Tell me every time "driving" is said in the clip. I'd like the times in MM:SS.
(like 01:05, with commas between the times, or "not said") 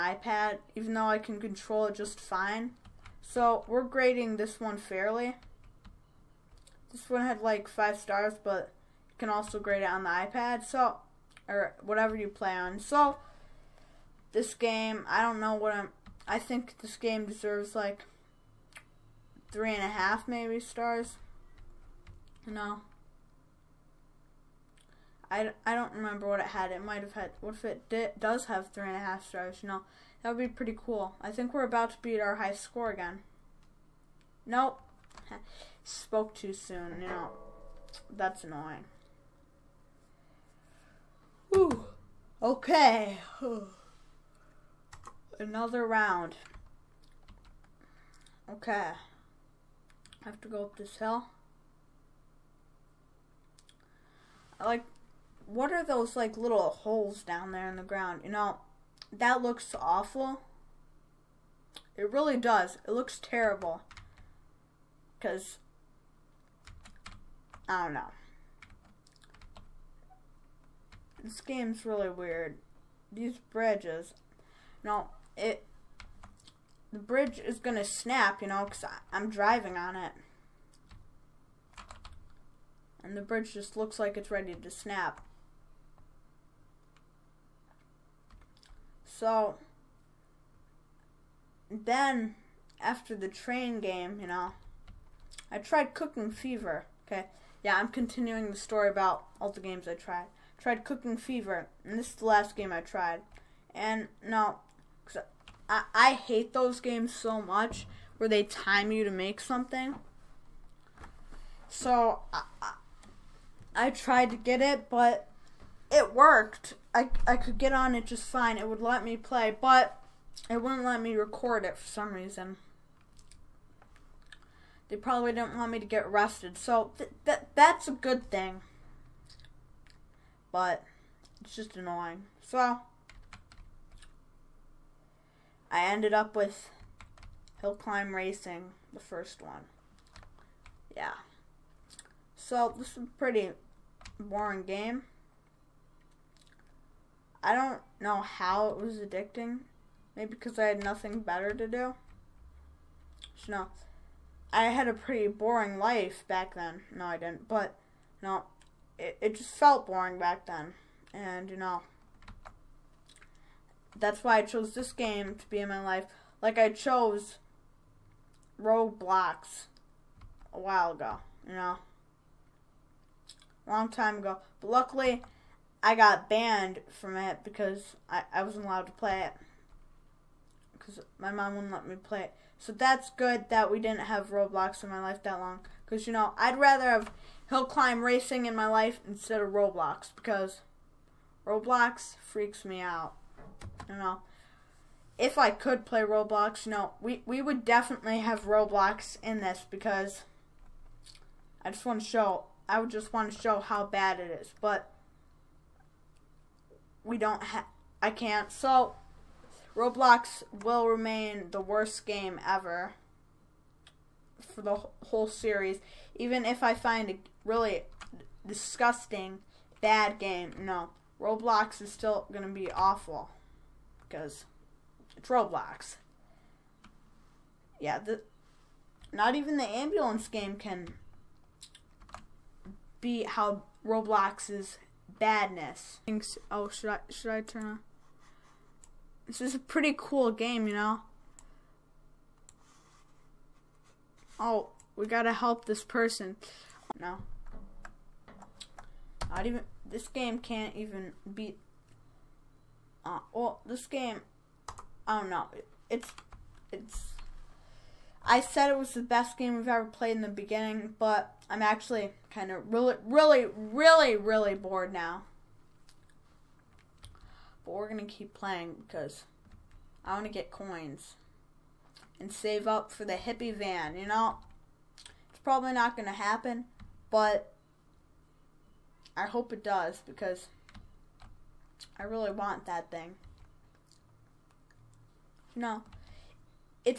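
01:19.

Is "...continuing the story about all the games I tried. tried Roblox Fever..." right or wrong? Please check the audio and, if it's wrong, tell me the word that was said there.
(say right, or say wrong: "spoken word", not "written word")
wrong: "Cooking", not "Roblox".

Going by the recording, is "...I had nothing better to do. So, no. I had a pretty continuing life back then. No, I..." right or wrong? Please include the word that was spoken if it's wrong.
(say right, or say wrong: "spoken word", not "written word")
wrong: "boring", not "continuing".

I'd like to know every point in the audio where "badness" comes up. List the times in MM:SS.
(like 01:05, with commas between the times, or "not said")
03:55.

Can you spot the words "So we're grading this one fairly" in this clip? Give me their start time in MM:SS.
00:03.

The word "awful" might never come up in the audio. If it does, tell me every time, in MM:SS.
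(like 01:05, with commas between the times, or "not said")
00:59, 03:42.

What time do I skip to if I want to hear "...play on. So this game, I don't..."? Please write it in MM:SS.
00:12.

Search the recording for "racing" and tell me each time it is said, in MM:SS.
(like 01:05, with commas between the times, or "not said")
02:18, 03:08.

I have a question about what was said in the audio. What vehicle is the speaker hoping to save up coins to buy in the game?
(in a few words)
hippie van.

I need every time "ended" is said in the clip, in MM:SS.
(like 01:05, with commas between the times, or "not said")
02:15.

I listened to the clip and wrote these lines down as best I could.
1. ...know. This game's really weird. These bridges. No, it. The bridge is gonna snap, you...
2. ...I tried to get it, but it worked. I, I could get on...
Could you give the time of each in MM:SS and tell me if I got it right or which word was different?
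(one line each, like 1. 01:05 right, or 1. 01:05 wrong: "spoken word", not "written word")
1. 01:07 right
2. 01:53 right.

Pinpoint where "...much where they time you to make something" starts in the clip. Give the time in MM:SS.
01:47.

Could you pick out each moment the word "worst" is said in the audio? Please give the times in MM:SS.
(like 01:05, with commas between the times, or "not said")
03:31.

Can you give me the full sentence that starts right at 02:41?
And, you know, that's why I chose this game to be in my life.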